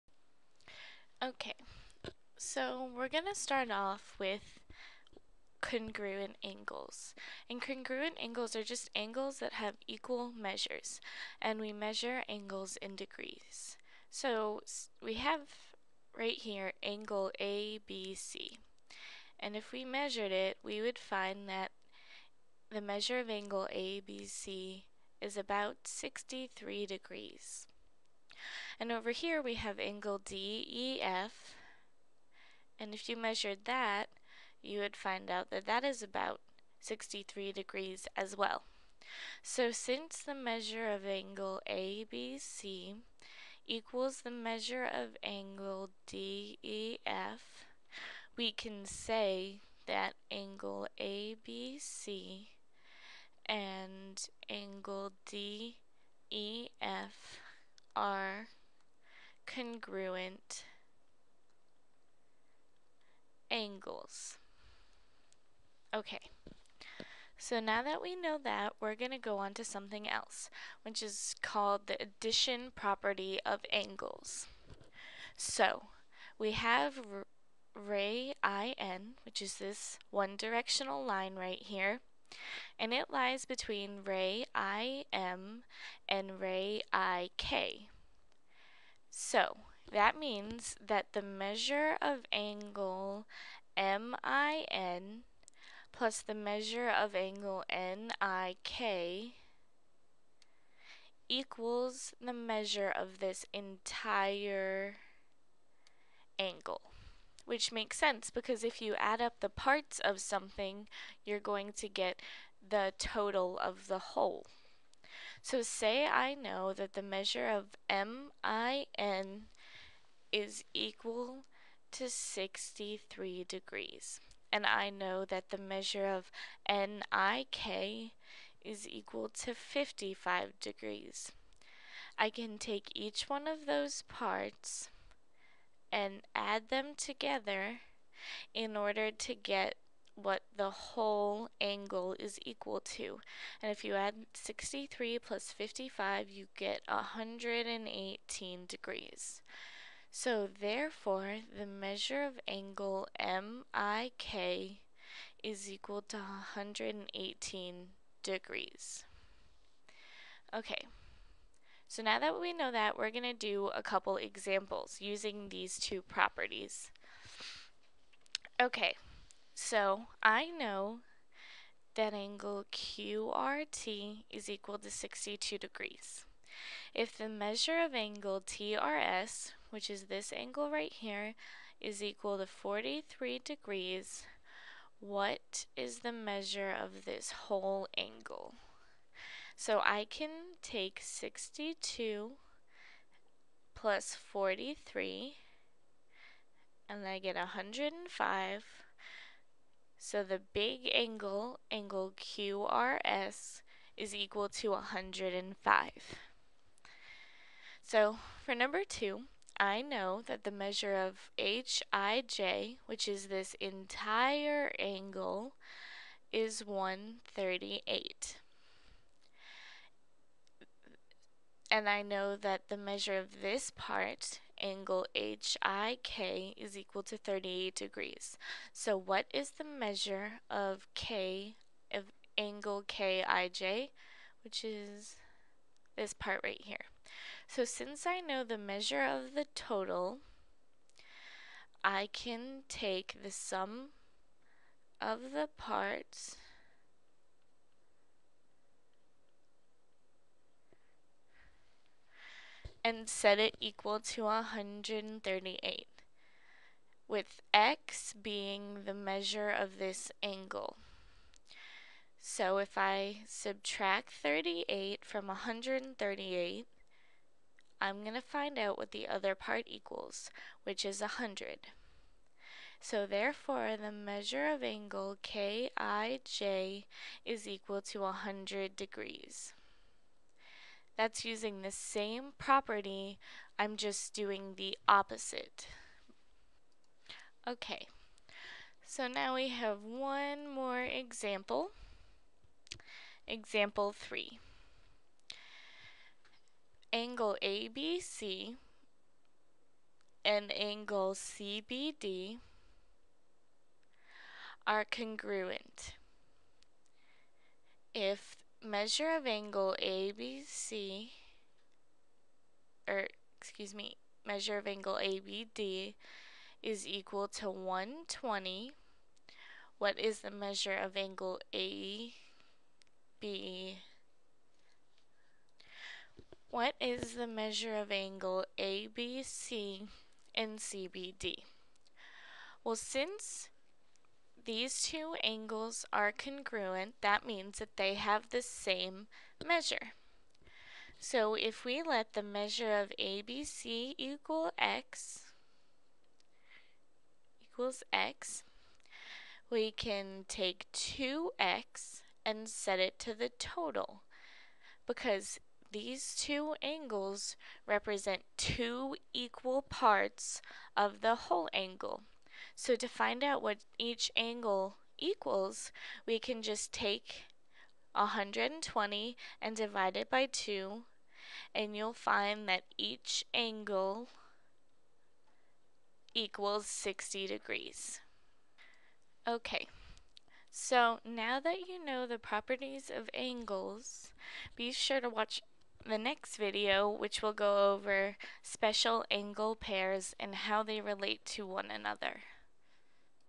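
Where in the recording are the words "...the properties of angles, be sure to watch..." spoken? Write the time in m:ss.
6:22.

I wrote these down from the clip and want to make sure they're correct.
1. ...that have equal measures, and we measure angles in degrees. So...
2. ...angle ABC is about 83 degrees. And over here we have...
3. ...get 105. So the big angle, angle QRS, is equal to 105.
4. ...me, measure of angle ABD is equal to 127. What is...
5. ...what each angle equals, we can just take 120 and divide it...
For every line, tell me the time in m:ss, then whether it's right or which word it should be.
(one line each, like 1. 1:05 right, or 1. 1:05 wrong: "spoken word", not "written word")
1. 0:09 right
2. 0:23 wrong: "63", not "83"
3. 3:17 right
4. 5:13 wrong: "120", not "127"
5. 6:03 right.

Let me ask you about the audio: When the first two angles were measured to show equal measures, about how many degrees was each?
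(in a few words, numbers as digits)
63 degrees.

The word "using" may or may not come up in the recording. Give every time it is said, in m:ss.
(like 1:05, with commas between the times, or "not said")
2:45, 4:41.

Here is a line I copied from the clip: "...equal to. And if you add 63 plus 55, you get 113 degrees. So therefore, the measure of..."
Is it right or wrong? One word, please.
wrong.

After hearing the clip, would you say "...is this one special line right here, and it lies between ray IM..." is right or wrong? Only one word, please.
wrong.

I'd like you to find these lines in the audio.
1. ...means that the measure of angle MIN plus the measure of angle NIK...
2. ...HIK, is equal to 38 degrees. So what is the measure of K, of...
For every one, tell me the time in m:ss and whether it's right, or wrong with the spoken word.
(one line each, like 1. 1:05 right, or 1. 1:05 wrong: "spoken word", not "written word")
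1. 1:30 right
2. 3:45 right.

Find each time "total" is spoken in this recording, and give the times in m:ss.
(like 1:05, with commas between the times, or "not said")
1:52, 3:59, 5:53.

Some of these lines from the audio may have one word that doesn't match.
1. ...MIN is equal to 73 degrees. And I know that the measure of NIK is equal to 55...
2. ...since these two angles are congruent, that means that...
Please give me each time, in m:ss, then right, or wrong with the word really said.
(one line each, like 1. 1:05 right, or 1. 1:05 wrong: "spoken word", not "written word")
1. 1:57 wrong: "63", not "73"
2. 5:32 right.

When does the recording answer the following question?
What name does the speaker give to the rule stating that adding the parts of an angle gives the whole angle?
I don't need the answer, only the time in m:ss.
1:12.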